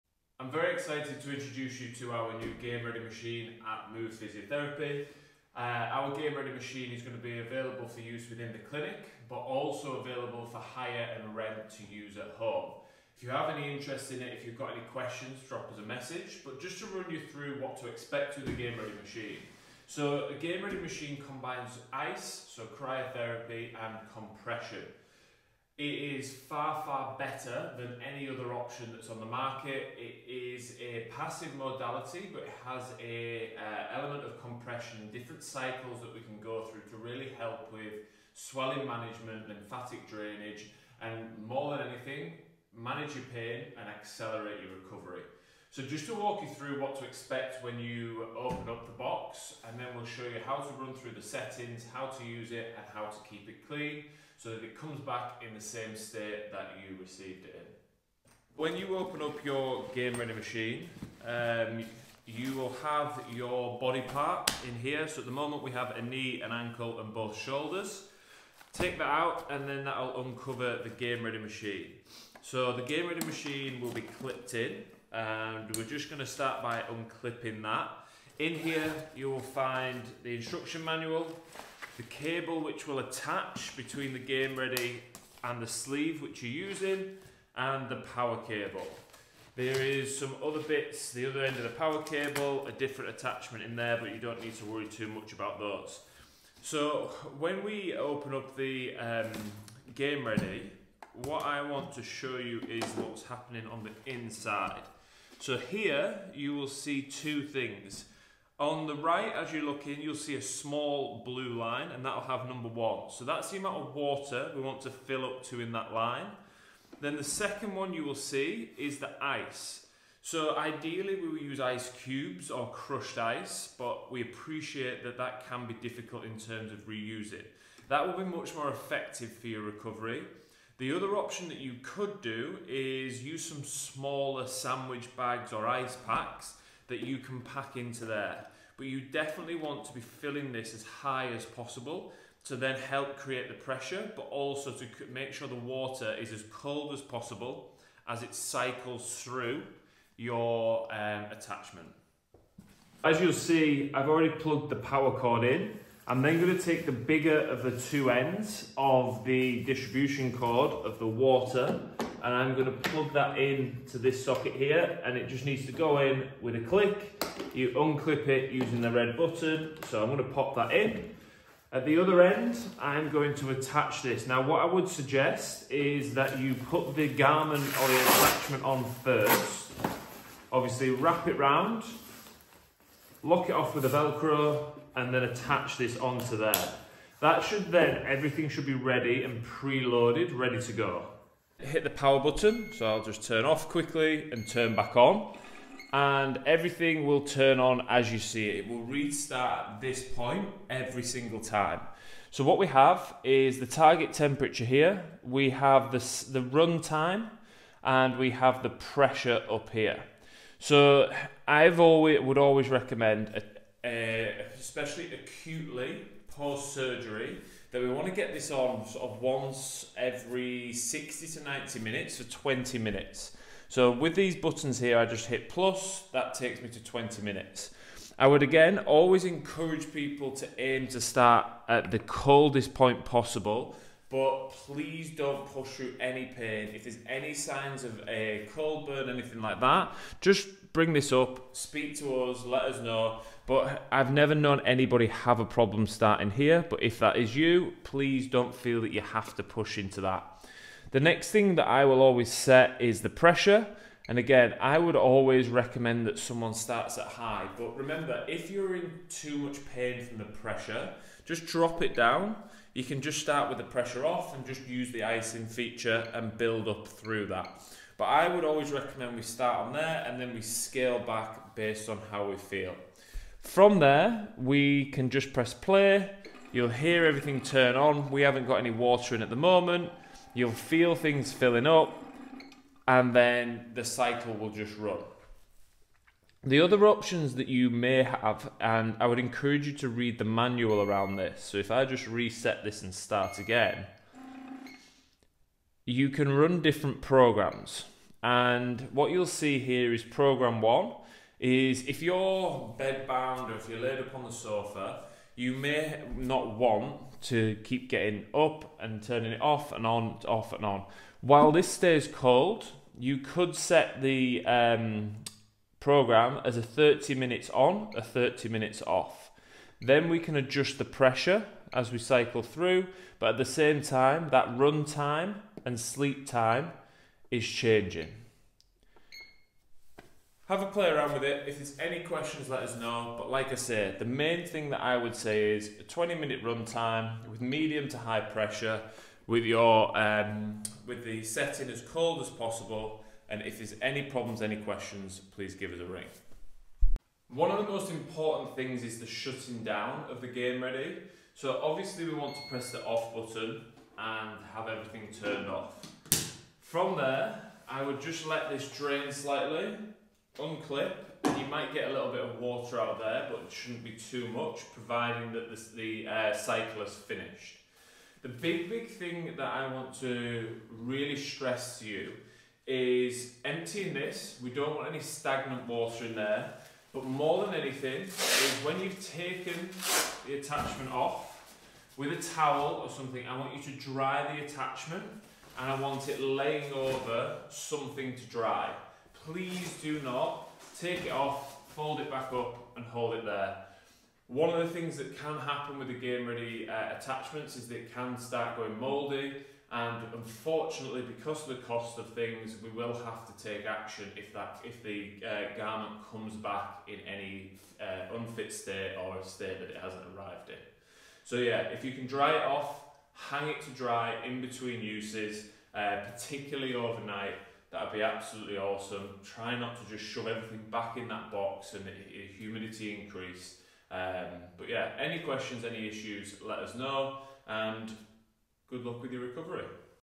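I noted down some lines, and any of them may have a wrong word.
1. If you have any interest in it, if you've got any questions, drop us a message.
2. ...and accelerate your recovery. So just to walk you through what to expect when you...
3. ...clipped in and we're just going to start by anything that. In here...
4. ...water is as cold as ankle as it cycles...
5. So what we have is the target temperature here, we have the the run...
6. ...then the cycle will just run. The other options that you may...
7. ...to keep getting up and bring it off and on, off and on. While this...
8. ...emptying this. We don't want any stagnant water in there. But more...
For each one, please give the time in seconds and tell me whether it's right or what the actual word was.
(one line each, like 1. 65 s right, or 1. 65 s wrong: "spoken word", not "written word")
1. 13 s right
2. 43 s right
3. 74 s wrong: "unclipping", not "anything"
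4. 145 s wrong: "possible", not "ankle"
5. 202 s right
6. 283 s right
7. 307 s wrong: "turning", not "bring"
8. 373 s right.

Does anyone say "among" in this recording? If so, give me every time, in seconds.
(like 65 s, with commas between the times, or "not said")
not said.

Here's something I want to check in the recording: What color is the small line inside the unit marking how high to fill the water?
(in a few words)
blue.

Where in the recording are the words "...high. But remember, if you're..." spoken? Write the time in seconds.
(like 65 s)
257 s.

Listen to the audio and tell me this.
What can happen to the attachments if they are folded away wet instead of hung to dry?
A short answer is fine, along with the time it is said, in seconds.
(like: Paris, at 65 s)
mouldy, at 398 s.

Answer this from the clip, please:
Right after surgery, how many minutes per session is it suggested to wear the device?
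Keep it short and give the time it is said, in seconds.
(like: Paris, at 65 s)
60 to 90 minutes, at 220 s.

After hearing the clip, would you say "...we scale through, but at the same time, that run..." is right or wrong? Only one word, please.
wrong.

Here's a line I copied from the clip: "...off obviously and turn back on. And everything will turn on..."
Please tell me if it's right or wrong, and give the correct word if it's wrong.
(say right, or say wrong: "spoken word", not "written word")
wrong: "quickly", not "obviously".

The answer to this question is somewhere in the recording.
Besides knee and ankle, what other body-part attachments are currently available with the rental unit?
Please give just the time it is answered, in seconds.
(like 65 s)
67 s.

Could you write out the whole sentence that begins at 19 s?
So, a Game Ready machine combines ice, so cryotherapy, and compression.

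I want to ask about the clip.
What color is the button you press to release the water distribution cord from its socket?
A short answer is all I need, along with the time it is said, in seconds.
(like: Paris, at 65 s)
red, at 168 s.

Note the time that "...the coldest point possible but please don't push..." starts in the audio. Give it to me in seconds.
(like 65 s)
231 s.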